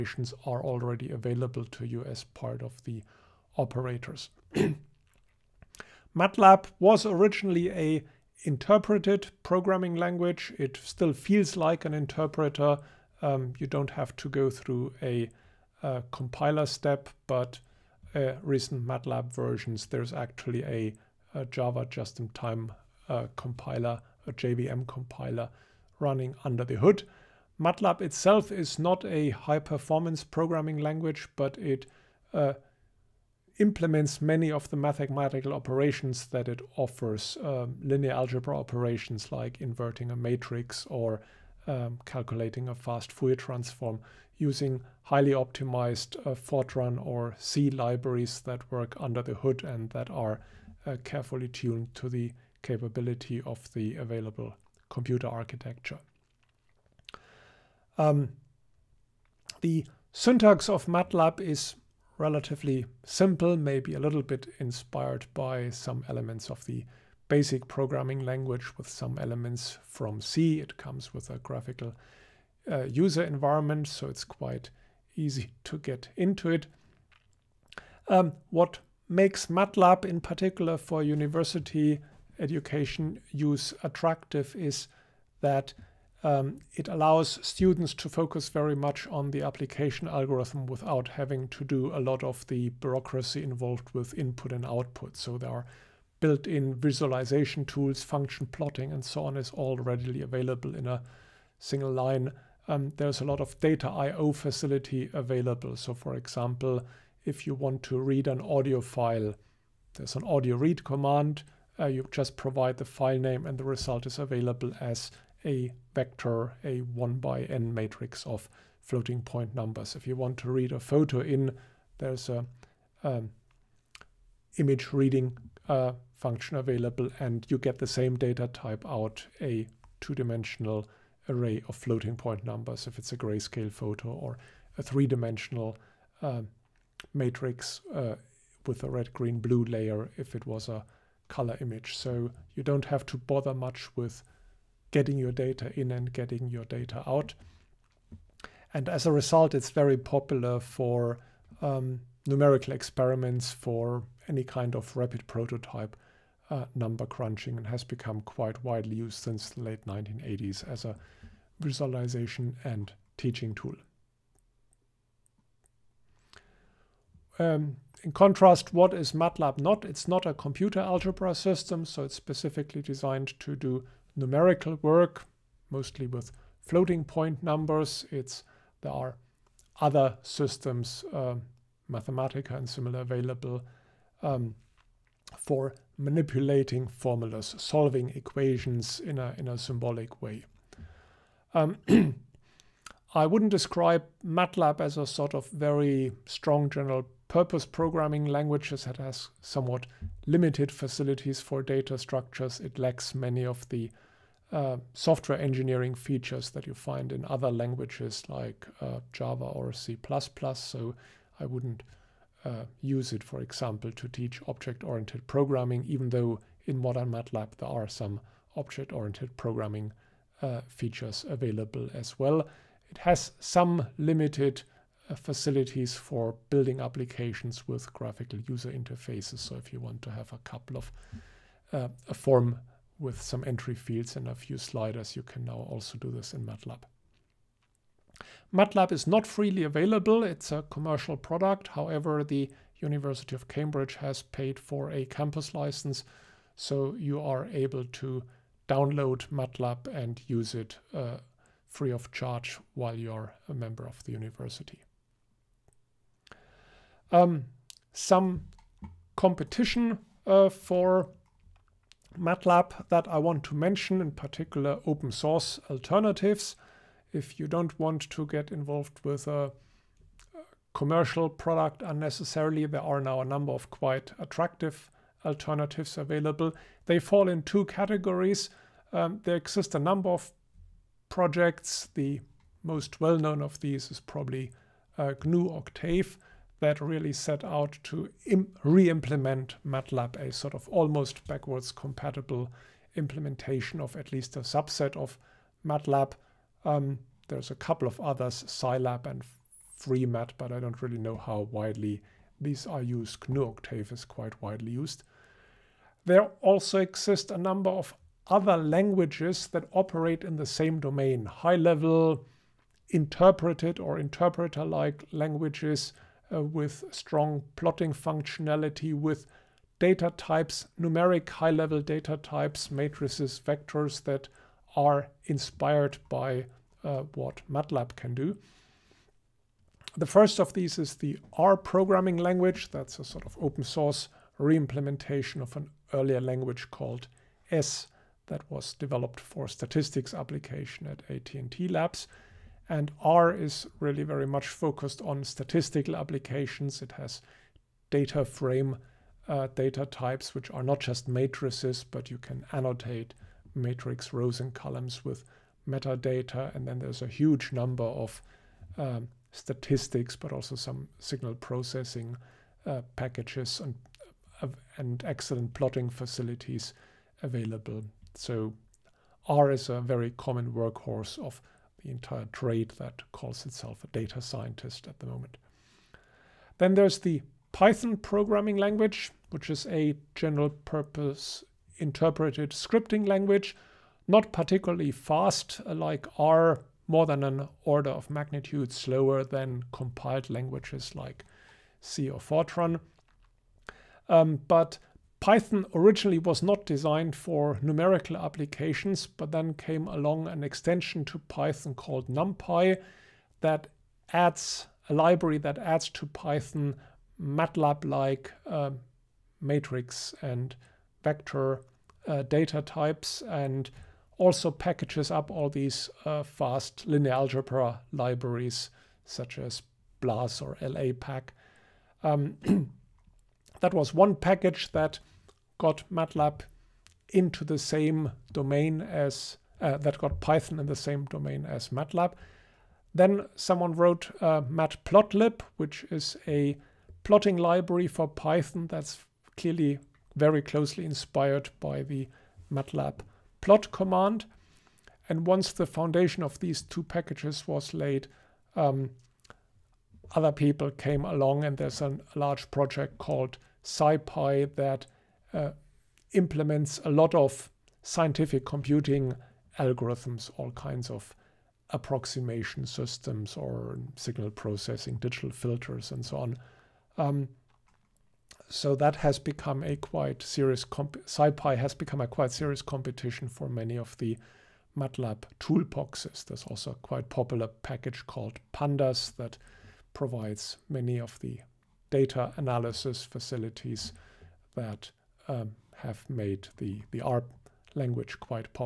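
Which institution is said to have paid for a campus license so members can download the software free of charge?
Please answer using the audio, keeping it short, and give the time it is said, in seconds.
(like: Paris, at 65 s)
University of Cambridge, at 242 s.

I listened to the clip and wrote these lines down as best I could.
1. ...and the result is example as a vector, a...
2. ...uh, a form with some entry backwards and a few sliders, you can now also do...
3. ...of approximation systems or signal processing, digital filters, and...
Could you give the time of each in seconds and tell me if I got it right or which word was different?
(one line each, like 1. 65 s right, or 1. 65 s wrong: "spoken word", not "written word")
1. 113 s wrong: "available", not "example"
2. 231 s wrong: "fields", not "backwards"
3. 460 s right.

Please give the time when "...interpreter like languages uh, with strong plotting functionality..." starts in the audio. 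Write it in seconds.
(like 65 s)
313 s.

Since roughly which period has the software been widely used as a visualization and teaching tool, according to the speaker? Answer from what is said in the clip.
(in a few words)
late 1980s.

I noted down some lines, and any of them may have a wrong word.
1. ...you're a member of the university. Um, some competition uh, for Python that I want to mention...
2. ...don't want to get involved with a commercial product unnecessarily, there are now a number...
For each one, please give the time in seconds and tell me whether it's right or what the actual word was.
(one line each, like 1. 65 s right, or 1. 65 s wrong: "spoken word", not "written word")
1. 252 s wrong: "MATLAB", not "Python"
2. 267 s right.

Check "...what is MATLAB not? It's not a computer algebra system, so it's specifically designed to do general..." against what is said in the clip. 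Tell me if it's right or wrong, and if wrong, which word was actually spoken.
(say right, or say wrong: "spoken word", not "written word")
wrong: "numerical", not "general".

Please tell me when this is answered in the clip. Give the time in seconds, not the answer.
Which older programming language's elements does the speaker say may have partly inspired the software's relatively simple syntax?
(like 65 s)
67 s.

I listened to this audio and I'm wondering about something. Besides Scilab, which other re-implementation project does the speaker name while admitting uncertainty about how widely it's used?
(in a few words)
FreeMat.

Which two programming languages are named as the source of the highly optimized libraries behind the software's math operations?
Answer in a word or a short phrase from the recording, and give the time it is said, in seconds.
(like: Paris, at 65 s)
Fortran or C, at 46 s.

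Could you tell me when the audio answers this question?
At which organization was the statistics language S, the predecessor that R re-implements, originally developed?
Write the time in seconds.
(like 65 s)
341 s.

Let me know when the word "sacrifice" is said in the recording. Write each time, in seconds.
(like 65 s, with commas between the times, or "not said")
not said.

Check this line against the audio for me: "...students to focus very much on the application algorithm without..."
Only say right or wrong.
right.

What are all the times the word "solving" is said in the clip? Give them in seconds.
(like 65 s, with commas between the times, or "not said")
187 s.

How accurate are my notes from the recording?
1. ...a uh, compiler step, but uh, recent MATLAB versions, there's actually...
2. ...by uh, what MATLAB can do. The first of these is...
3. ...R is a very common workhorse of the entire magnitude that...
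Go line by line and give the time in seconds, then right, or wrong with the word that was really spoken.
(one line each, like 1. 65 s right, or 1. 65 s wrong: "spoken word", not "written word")
1. 15 s right
2. 326 s right
3. 369 s wrong: "trade", not "magnitude".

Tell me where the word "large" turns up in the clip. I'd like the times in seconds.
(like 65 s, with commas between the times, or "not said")
452 s.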